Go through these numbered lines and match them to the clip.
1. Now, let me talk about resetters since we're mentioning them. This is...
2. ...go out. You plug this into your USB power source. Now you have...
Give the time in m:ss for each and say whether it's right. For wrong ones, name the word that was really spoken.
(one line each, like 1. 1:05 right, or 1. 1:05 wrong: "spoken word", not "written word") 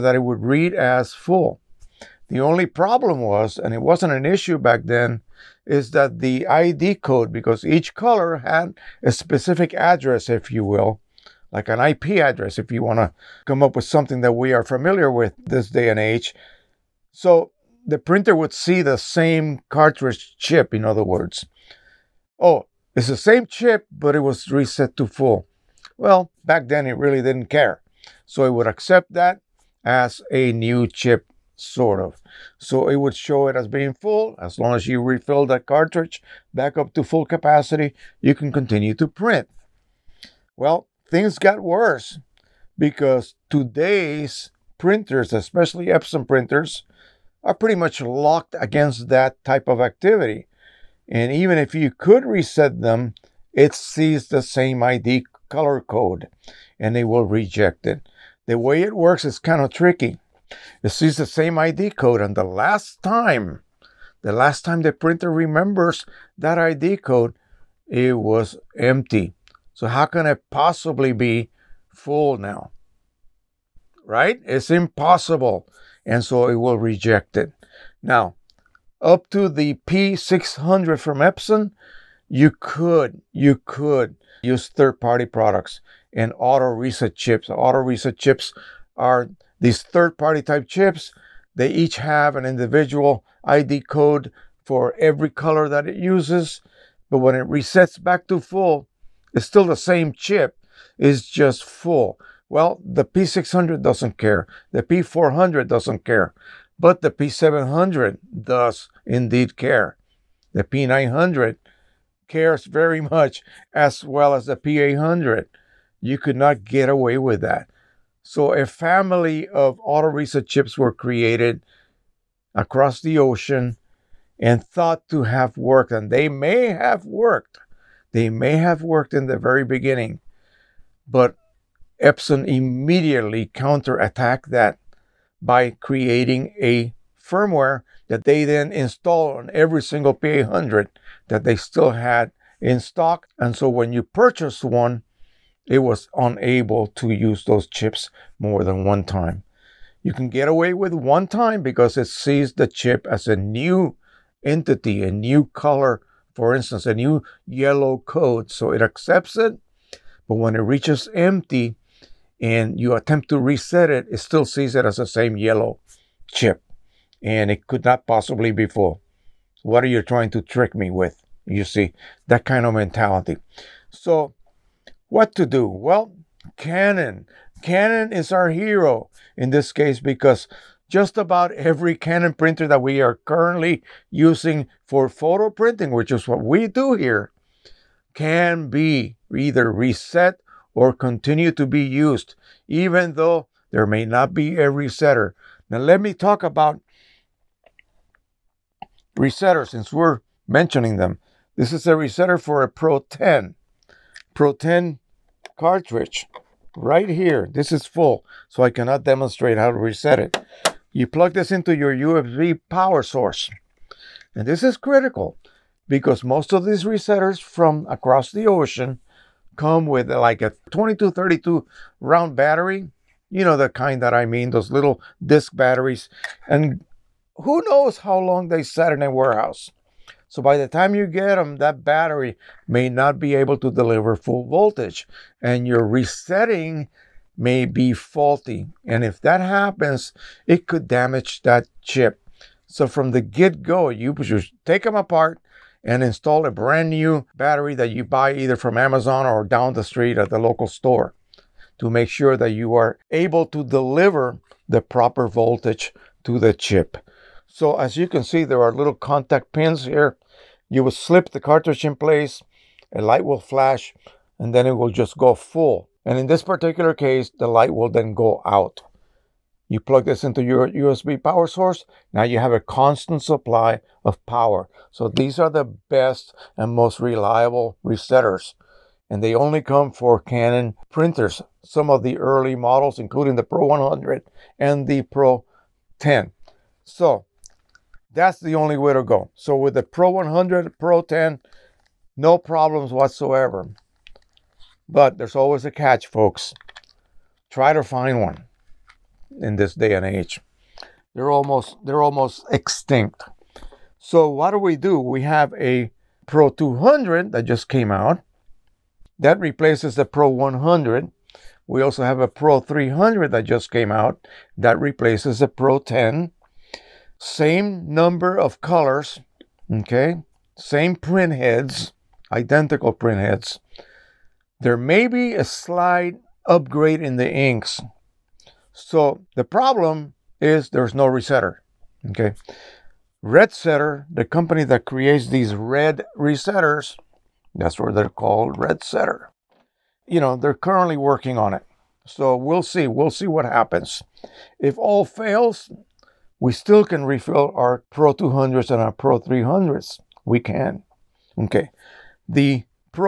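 1. 3:15 right
2. 4:28 right.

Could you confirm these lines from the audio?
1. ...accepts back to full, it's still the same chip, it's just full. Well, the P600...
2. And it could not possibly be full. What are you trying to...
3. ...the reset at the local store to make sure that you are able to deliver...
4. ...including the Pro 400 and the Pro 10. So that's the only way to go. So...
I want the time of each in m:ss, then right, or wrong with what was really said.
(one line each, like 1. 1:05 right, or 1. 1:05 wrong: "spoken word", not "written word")
1. 1:37 wrong: "resets", not "accepts"
2. 2:47 right
3. 4:09 wrong: "street", not "reset"
4. 4:42 wrong: "100", not "400".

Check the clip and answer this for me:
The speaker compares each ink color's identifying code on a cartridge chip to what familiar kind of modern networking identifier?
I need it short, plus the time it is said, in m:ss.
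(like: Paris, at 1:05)
IP address, at 0:11.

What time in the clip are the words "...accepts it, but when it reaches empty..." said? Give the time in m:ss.
2:38.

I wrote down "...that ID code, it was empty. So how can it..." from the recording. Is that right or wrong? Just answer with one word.
right.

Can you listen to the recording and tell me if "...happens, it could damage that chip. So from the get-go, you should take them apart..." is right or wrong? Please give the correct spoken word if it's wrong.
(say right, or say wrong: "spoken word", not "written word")
right.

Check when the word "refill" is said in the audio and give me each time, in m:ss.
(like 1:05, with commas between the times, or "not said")
0:35, 5:47.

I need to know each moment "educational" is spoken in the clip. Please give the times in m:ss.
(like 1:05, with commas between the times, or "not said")
not said.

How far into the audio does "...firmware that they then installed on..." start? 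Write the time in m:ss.
2:17.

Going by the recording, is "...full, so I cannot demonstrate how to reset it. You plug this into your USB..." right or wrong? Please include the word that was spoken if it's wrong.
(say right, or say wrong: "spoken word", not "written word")
right.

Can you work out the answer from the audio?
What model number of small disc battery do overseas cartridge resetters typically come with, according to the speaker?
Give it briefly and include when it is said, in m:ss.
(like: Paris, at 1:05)
2232, at 3:40.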